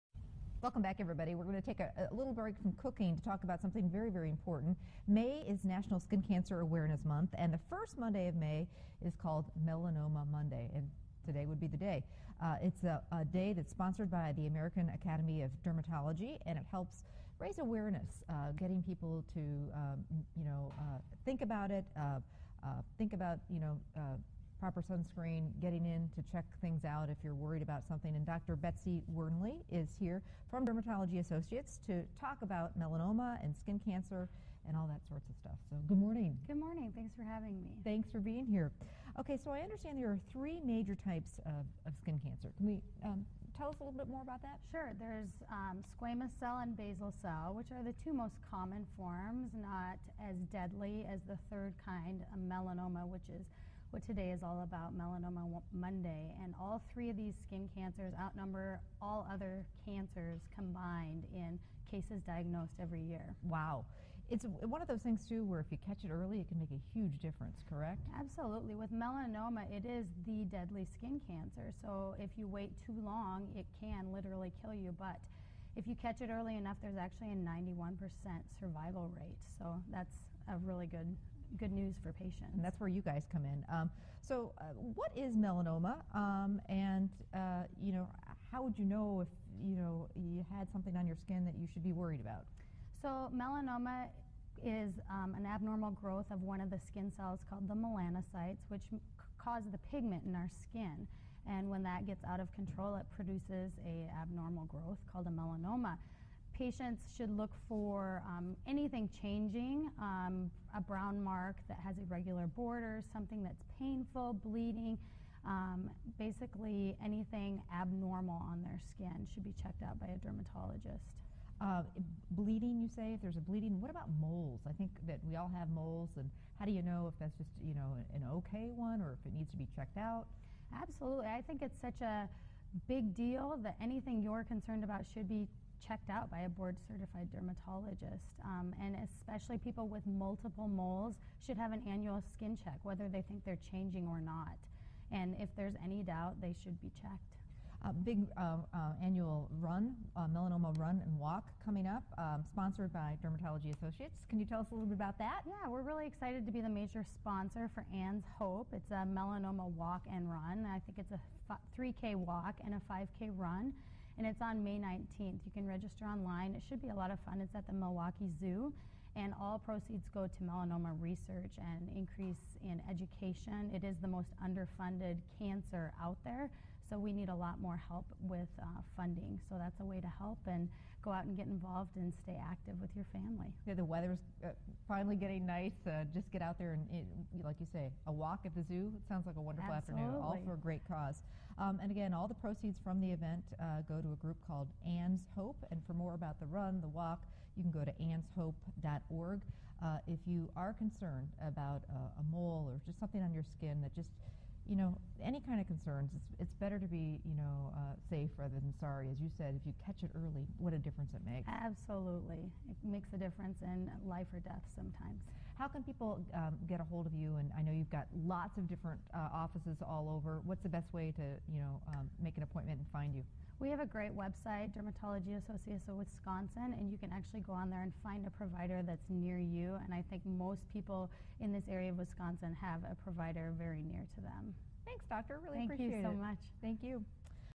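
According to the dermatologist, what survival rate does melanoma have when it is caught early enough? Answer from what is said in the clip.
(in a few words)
91%.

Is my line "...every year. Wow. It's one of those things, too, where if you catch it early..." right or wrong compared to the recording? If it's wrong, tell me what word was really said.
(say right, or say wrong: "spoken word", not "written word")
right.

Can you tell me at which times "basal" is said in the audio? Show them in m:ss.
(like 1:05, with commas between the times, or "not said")
0:46.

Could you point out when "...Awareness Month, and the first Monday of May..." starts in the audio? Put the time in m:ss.
0:06.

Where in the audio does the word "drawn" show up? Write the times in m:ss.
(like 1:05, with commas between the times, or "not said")
not said.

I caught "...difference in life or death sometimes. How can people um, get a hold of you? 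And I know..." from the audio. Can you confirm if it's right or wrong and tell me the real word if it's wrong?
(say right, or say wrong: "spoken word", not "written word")
right.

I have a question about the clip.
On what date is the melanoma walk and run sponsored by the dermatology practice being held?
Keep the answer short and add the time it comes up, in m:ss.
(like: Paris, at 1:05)
May 19th, at 2:44.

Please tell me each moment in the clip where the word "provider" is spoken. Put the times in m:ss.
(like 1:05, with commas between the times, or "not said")
3:48, 3:53.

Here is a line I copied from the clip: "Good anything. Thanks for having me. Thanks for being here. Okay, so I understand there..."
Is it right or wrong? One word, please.
wrong.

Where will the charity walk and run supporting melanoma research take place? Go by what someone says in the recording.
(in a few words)
Milwaukee Zoo.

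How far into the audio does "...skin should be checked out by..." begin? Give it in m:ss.
1:58.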